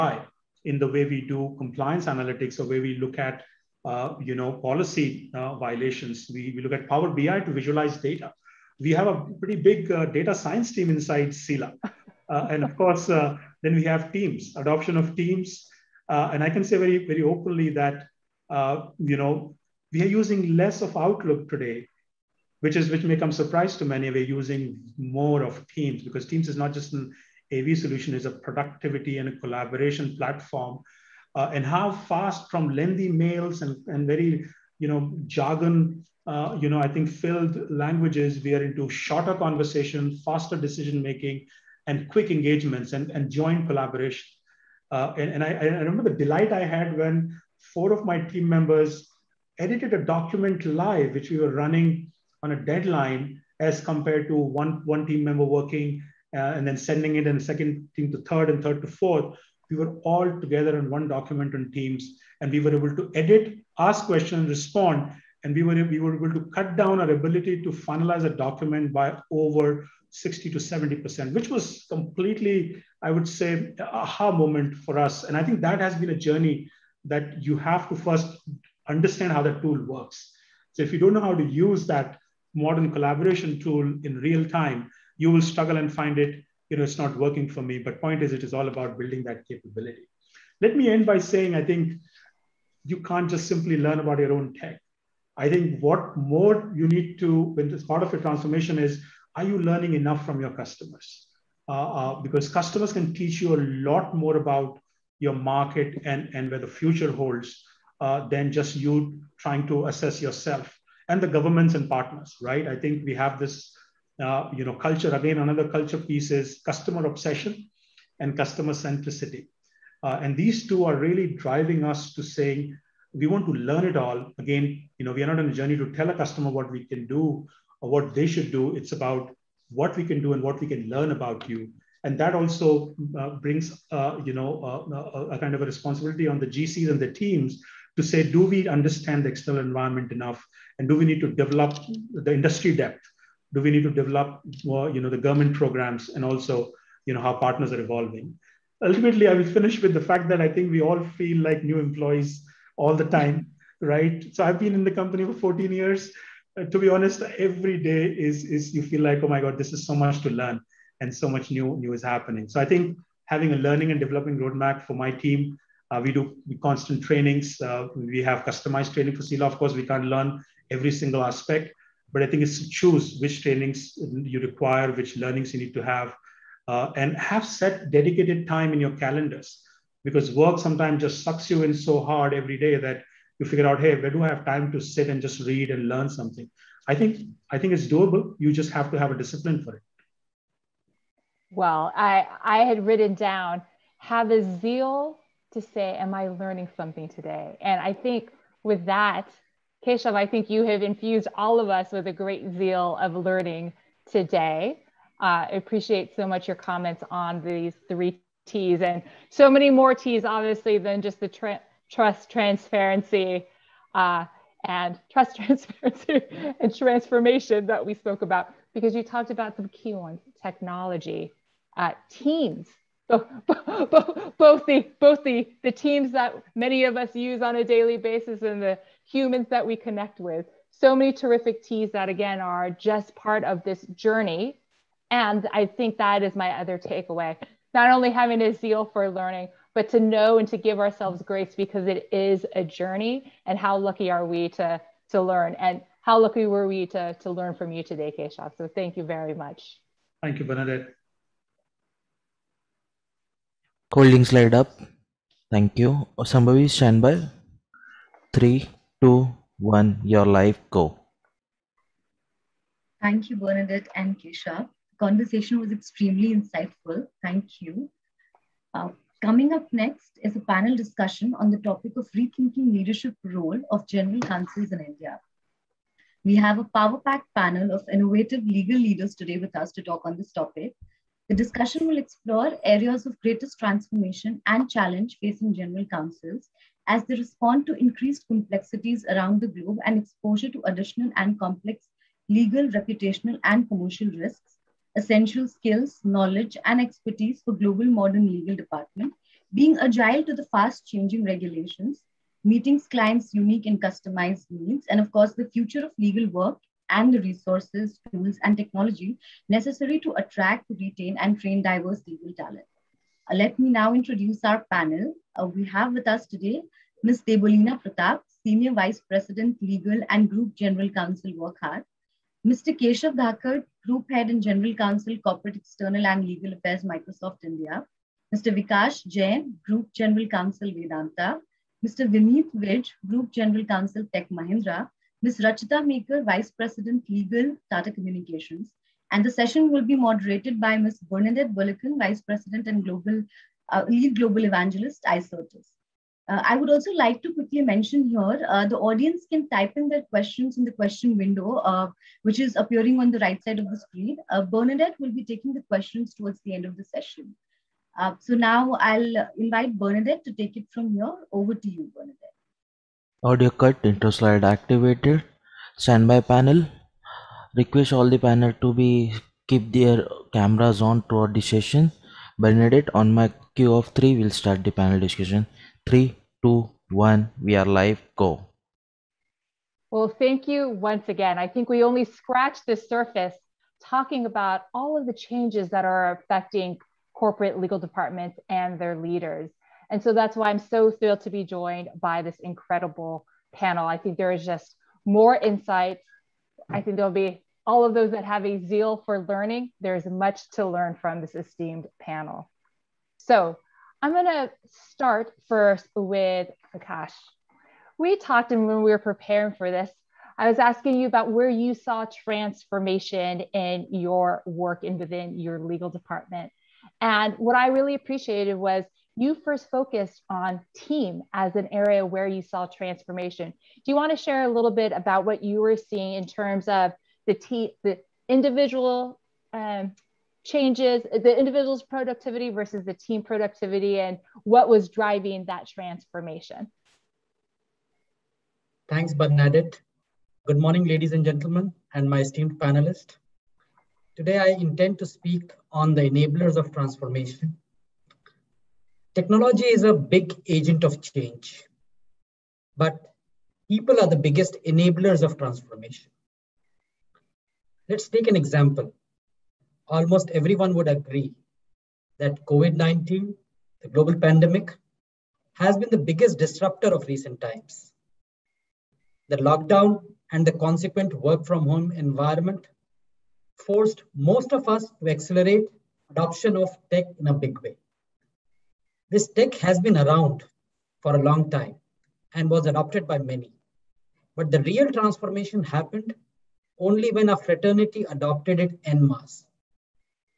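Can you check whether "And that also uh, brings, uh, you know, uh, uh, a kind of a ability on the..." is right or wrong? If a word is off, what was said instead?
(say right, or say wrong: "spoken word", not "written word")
wrong: "responsibility", not "ability".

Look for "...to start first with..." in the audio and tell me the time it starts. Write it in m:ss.
6:44.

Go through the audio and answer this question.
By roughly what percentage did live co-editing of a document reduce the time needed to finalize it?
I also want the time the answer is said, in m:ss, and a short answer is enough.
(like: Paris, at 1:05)
60 to 70%, at 1:10.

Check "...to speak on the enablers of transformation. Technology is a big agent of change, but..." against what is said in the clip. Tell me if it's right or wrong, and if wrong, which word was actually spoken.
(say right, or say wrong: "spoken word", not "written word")
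right.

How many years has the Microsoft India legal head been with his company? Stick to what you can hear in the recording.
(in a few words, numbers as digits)
14.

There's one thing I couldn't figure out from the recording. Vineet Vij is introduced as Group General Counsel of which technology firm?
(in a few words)
Tech Mahindra.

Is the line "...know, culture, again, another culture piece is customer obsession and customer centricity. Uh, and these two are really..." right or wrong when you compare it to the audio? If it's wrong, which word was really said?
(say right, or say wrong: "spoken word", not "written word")
right.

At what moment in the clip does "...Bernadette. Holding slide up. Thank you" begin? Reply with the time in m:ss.
4:10.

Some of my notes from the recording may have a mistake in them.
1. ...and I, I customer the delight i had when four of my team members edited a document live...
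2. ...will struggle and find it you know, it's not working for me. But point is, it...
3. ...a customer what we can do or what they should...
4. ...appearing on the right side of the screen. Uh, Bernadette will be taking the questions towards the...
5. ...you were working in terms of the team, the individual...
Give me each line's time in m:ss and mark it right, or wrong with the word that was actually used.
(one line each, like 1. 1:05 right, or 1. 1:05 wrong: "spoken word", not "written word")
1. 0:45 wrong: "remember", not "customer"
2. 1:25 right
3. 2:06 right
4. 5:52 right
5. 7:05 wrong: "seeing", not "working".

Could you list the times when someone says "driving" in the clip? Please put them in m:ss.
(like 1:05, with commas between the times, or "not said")
2:01, 7:14.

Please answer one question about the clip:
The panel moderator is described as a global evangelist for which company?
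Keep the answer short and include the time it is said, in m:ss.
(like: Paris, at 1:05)
Icertis, at 5:45.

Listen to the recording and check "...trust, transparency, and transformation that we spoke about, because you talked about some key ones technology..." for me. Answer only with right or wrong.
right.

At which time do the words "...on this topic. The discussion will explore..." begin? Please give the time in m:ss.
4:40.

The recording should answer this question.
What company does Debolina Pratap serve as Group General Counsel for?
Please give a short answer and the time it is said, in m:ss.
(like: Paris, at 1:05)
Wockhardt, at 5:21.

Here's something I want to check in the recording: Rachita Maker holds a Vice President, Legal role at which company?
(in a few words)
Tata Communications.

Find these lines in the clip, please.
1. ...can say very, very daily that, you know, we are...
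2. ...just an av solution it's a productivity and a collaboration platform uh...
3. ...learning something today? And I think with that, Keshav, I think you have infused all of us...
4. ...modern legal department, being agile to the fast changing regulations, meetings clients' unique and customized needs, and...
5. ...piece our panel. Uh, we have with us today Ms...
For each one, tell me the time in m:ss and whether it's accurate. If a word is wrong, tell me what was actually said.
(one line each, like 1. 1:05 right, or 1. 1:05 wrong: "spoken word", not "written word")
1. 0:16 wrong: "openly", not "daily"
2. 0:26 right
3. 3:16 right
4. 4:57 right
5. 5:13 wrong: "introduce", not "piece".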